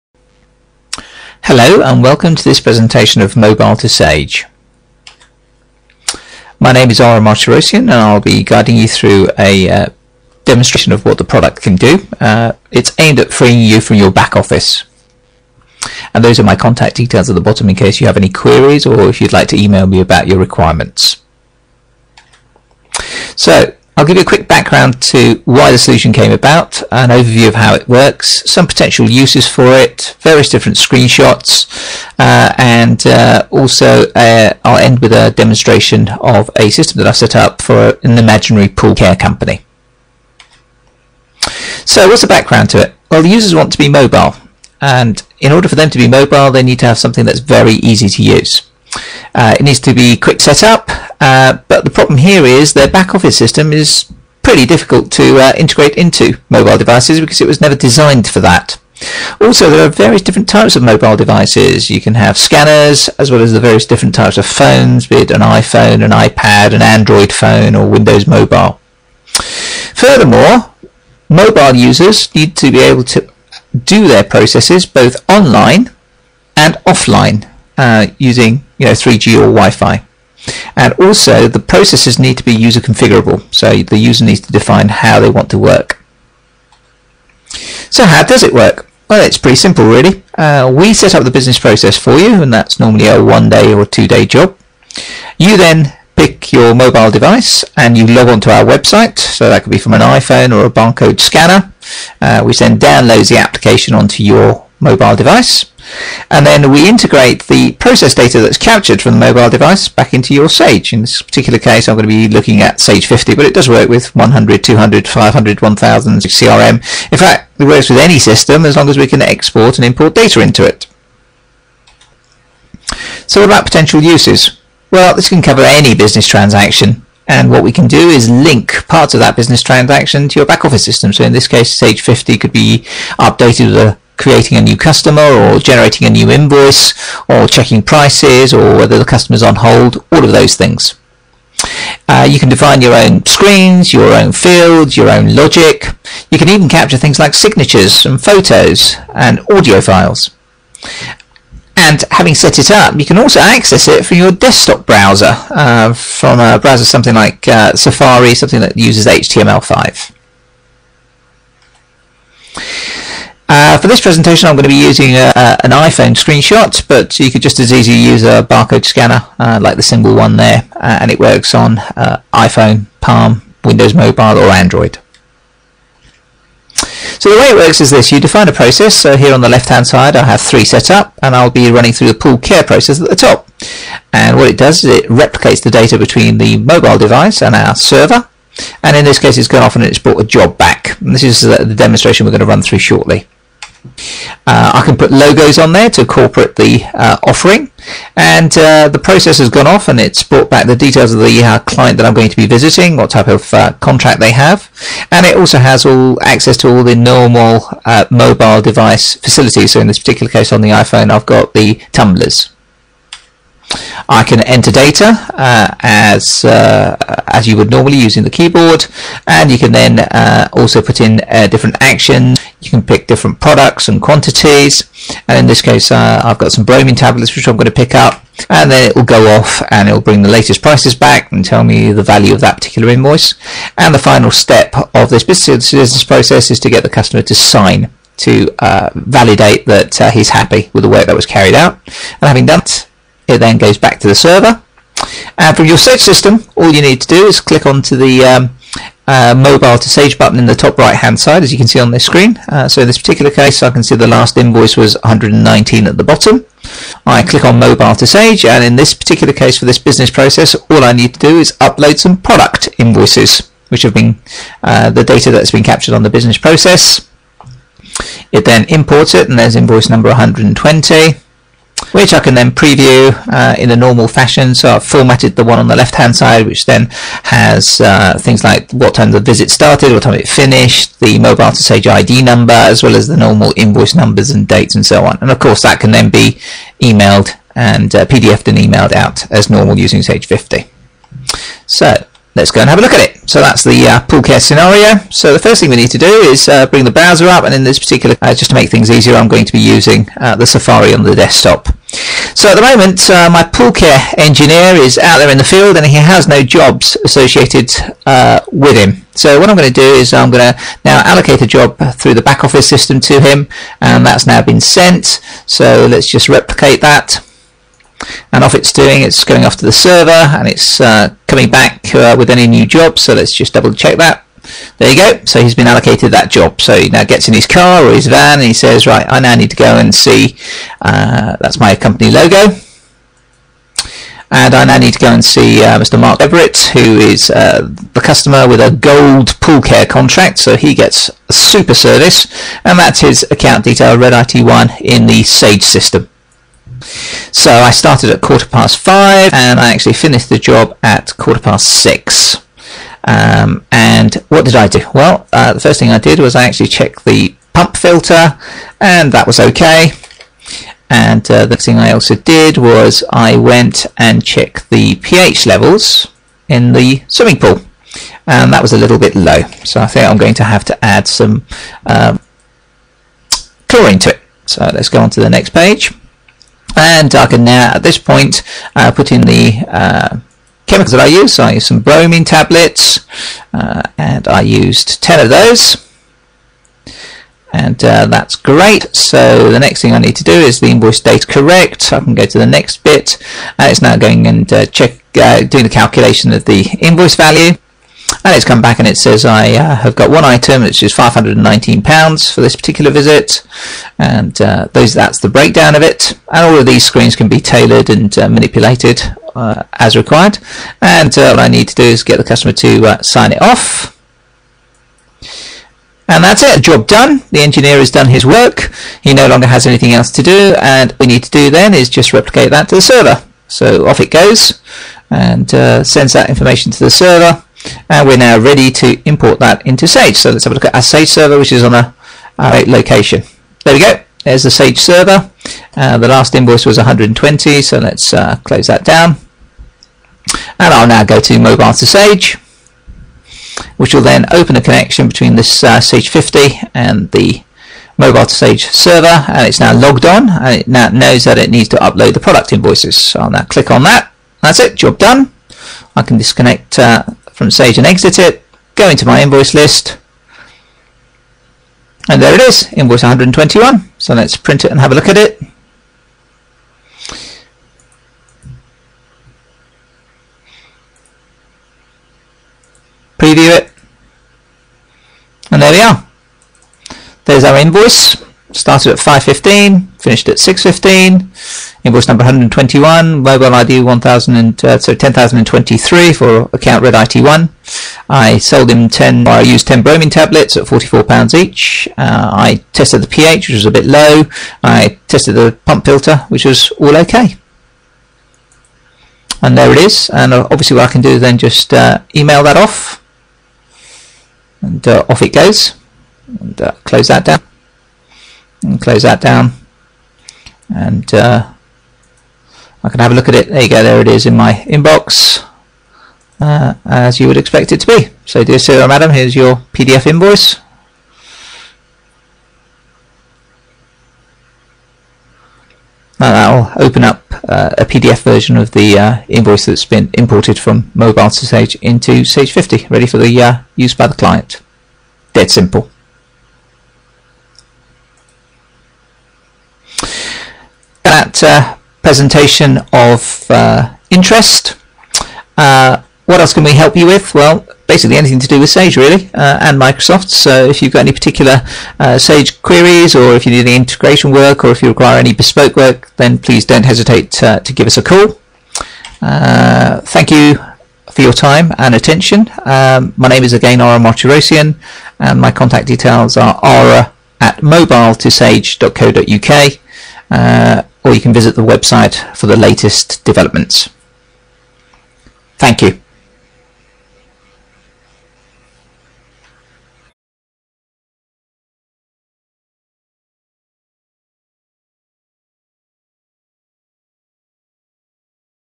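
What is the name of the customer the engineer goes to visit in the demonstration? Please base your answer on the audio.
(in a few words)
Mark Everett.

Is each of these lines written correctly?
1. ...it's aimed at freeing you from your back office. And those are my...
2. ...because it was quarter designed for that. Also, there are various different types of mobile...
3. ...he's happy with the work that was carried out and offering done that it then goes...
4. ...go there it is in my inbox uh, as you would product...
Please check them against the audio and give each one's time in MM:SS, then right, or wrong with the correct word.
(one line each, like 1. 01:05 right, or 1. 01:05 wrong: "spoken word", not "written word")
1. 00:12 right
2. 00:57 wrong: "never", not "quarter"
3. 04:00 wrong: "having", not "offering"
4. 08:33 wrong: "expect", not "product".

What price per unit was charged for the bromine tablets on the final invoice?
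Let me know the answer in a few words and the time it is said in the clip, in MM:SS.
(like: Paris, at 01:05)
£44, at 08:10.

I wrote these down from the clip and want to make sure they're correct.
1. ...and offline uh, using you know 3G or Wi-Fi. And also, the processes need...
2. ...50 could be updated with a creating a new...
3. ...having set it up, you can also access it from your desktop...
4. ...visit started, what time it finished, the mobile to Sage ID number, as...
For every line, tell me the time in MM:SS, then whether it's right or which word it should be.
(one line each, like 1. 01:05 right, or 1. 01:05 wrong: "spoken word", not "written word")
1. 01:16 right
2. 02:12 right
3. 02:32 right
4. 04:39 right.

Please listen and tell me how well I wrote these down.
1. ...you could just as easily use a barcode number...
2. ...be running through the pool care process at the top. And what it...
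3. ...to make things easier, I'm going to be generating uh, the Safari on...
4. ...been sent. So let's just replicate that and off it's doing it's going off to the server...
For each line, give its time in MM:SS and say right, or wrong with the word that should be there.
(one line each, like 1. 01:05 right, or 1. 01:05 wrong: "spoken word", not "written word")
1. 02:47 wrong: "scanner", not "number"
2. 03:01 right
3. 04:58 wrong: "using", not "generating"
4. 05:14 right.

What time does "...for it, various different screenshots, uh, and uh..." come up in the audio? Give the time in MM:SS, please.
00:29.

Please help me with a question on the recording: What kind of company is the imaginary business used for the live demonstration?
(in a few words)
pool care company.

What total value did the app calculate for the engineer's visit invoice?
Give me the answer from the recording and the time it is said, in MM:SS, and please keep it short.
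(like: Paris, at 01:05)
£519, at 06:40.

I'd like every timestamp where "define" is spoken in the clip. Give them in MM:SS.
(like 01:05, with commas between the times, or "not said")
01:24, 02:22, 02:58.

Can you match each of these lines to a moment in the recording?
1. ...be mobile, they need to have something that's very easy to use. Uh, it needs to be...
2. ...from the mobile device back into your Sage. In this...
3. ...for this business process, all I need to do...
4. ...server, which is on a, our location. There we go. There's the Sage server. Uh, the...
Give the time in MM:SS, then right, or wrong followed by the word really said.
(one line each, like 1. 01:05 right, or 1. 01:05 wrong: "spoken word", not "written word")
1. 00:45 right
2. 01:49 right
3. 04:19 right
4. 07:11 right.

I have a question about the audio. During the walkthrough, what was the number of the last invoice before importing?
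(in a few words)
119.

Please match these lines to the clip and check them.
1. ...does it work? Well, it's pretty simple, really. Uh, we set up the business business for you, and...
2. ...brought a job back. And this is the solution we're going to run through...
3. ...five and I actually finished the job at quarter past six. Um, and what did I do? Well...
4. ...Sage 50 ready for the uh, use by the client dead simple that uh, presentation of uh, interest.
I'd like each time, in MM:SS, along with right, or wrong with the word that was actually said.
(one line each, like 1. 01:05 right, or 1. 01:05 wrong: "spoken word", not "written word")
1. 01:28 wrong: "process", not "business"
2. 03:09 wrong: "demonstration", not "solution"
3. 05:48 right
4. 08:52 right.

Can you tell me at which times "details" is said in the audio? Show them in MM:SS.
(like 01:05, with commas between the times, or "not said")
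00:16, 03:20, 05:43, 09:25.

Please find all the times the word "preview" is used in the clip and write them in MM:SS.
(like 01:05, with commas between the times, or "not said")
04:32, 07:53.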